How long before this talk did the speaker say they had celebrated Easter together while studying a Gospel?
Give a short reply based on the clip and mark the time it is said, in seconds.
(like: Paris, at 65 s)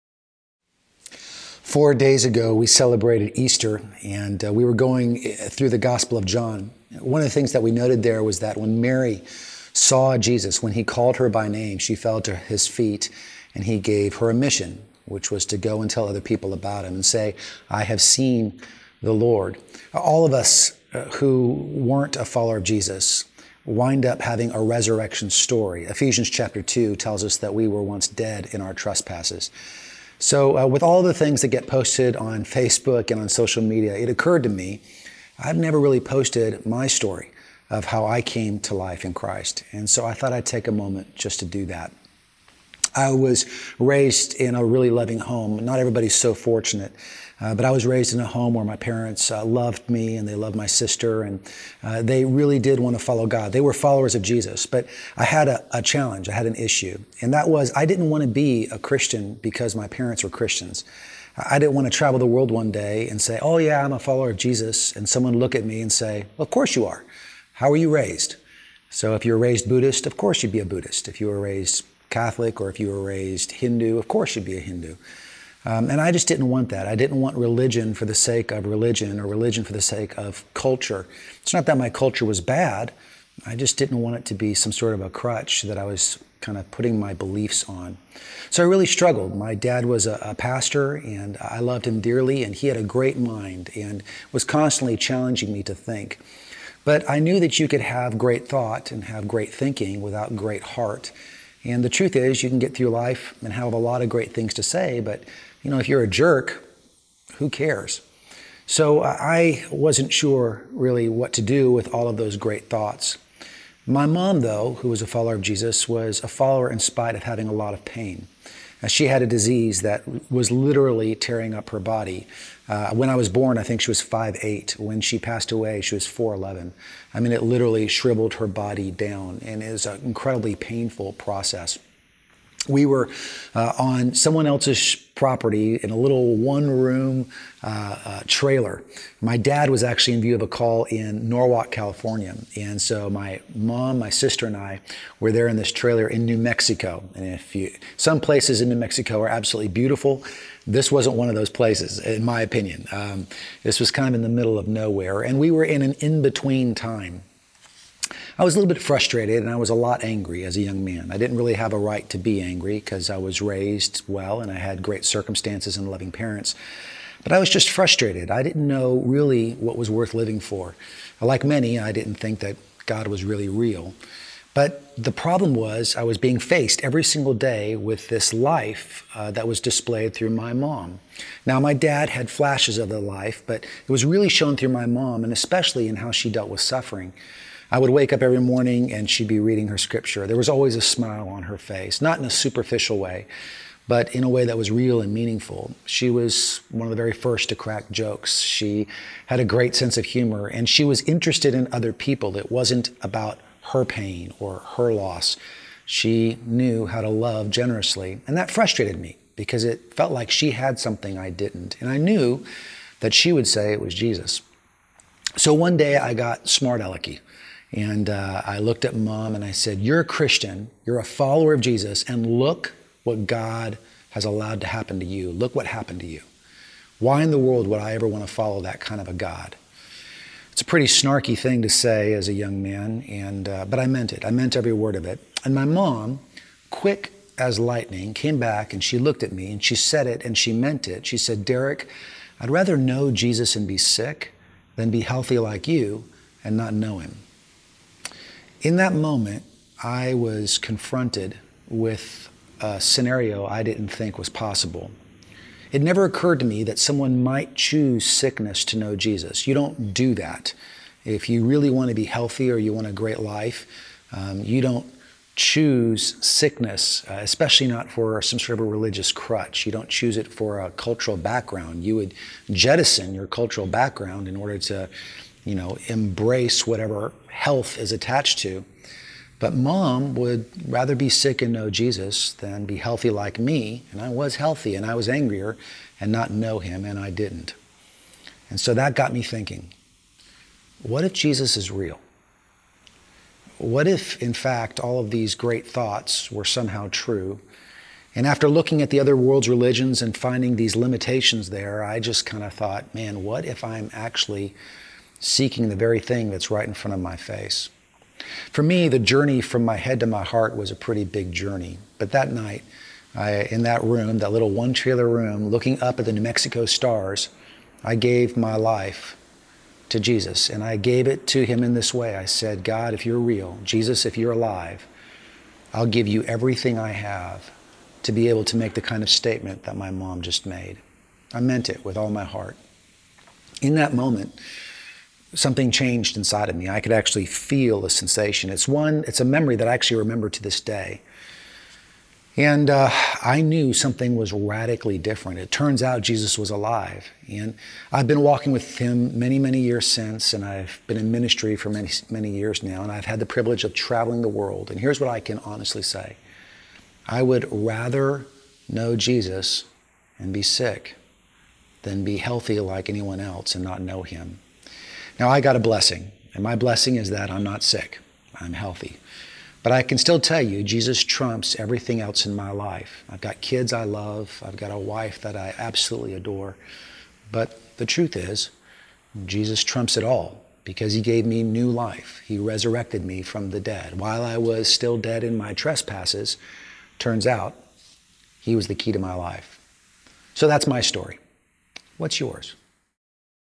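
4 days, at 1 s.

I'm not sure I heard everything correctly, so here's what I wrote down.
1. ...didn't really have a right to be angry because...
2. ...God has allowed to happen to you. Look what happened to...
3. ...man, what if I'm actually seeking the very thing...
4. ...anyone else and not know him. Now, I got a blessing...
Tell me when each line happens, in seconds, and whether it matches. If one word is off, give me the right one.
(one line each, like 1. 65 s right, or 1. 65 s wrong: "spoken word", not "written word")
1. 161 s right
2. 223 s right
3. 302 s right
4. 362 s right.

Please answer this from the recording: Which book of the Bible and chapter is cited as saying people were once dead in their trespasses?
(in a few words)
Ephesians chapter 2.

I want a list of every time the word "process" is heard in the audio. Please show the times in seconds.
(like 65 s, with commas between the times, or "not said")
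131 s.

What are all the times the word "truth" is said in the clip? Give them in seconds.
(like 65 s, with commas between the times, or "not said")
101 s, 377 s.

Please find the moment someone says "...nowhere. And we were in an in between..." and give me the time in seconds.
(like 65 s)
154 s.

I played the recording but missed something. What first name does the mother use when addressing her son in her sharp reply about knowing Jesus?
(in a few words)
Derek.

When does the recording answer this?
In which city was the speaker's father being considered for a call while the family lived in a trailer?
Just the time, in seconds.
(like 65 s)
141 s.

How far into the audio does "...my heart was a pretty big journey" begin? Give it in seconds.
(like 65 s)
310 s.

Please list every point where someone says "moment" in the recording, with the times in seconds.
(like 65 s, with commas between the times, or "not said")
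40 s, 248 s, 333 s.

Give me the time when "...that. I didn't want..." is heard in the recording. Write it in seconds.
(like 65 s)
76 s.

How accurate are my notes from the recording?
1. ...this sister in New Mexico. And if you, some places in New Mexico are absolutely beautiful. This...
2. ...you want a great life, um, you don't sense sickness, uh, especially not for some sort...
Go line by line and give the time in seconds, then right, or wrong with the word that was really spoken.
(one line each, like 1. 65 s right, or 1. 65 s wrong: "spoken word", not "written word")
1. 145 s wrong: "trailer", not "sister"
2. 262 s wrong: "choose", not "sense".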